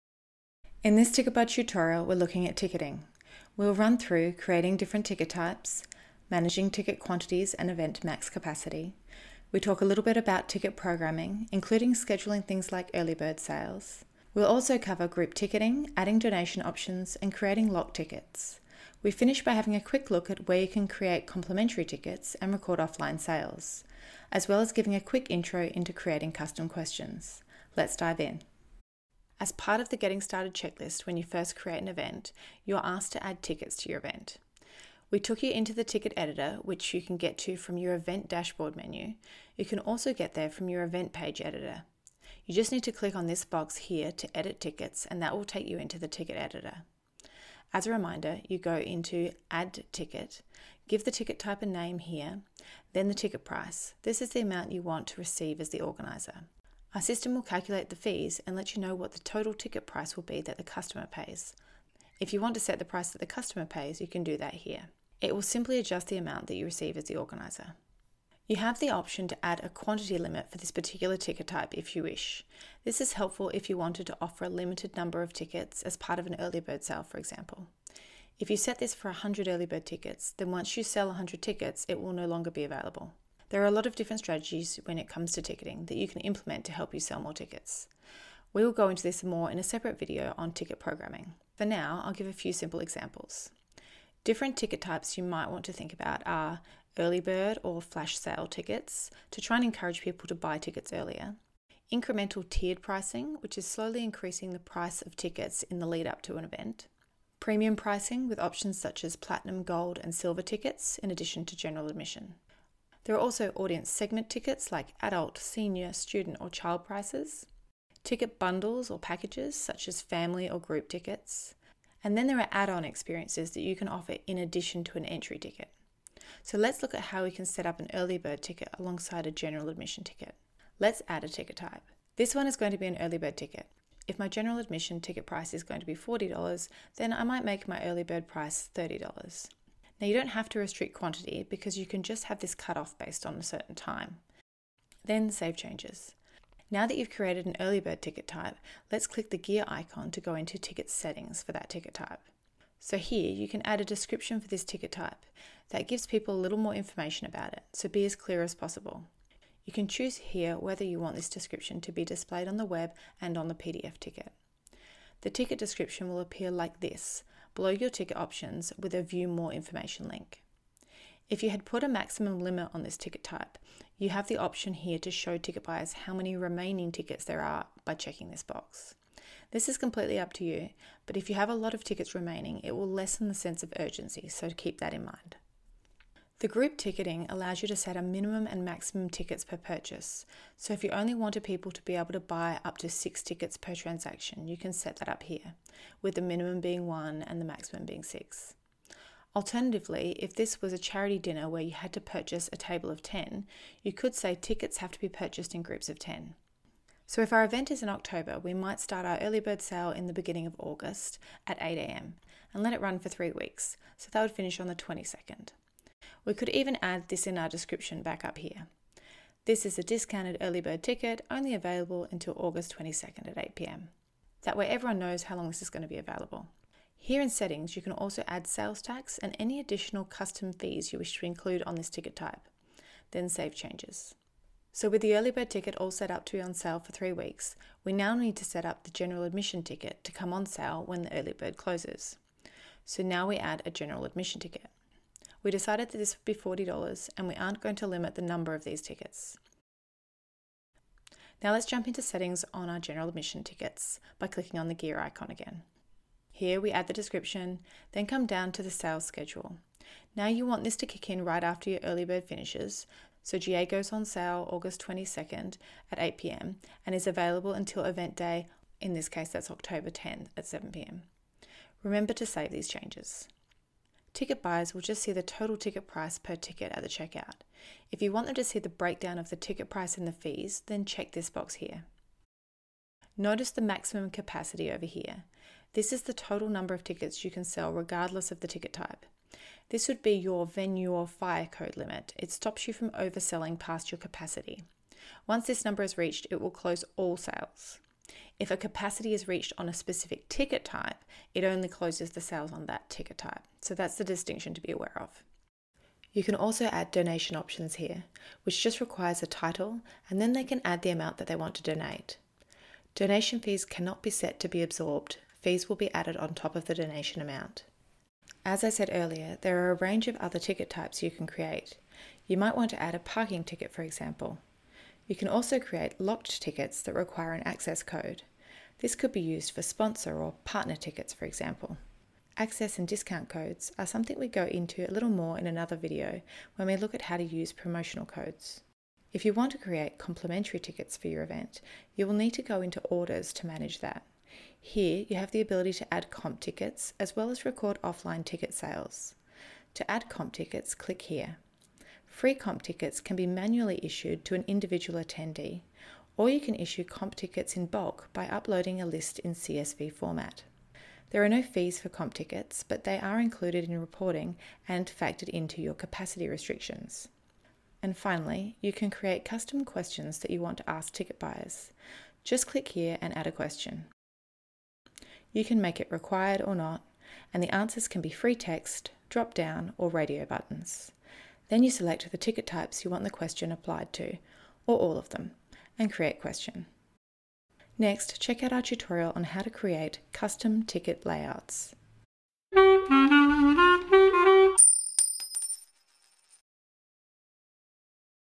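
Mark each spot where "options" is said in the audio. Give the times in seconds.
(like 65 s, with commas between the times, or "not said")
16 s, 68 s, 108 s, 168 s, 174 s, 307 s.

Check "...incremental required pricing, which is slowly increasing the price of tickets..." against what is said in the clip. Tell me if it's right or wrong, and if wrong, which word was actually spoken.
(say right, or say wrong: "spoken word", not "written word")
wrong: "tiered", not "required".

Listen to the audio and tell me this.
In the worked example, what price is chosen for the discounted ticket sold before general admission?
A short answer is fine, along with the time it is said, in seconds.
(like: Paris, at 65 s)
$30, at 138 s.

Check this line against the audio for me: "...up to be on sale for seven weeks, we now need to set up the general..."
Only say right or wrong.
wrong.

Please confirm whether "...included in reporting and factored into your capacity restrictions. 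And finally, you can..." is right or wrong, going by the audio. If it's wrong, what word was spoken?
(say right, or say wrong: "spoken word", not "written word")
right.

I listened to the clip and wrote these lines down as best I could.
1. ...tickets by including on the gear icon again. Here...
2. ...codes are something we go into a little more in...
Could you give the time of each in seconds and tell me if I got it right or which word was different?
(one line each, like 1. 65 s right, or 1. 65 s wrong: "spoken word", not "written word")
1. 253 s wrong: "clicking", not "including"
2. 333 s right.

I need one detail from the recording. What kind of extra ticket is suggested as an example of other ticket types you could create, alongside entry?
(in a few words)
parking ticket.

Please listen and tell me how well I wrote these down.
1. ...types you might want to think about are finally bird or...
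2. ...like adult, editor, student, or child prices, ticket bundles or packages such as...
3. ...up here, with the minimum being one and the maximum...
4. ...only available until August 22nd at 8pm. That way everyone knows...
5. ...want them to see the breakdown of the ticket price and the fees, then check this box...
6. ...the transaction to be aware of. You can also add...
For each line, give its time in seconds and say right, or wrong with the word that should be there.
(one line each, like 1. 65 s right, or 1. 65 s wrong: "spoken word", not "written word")
1. 94 s wrong: "early", not "finally"
2. 114 s wrong: "senior", not "editor"
3. 195 s right
4. 221 s right
5. 278 s right
6. 303 s wrong: "distinction", not "transaction".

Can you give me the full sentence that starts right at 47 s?
As a reminder, you go into Add Ticket, give the ticket type a name here, then the ticket price.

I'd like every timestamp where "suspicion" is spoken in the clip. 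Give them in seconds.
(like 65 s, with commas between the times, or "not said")
not said.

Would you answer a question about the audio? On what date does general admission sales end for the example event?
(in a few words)
October 10th.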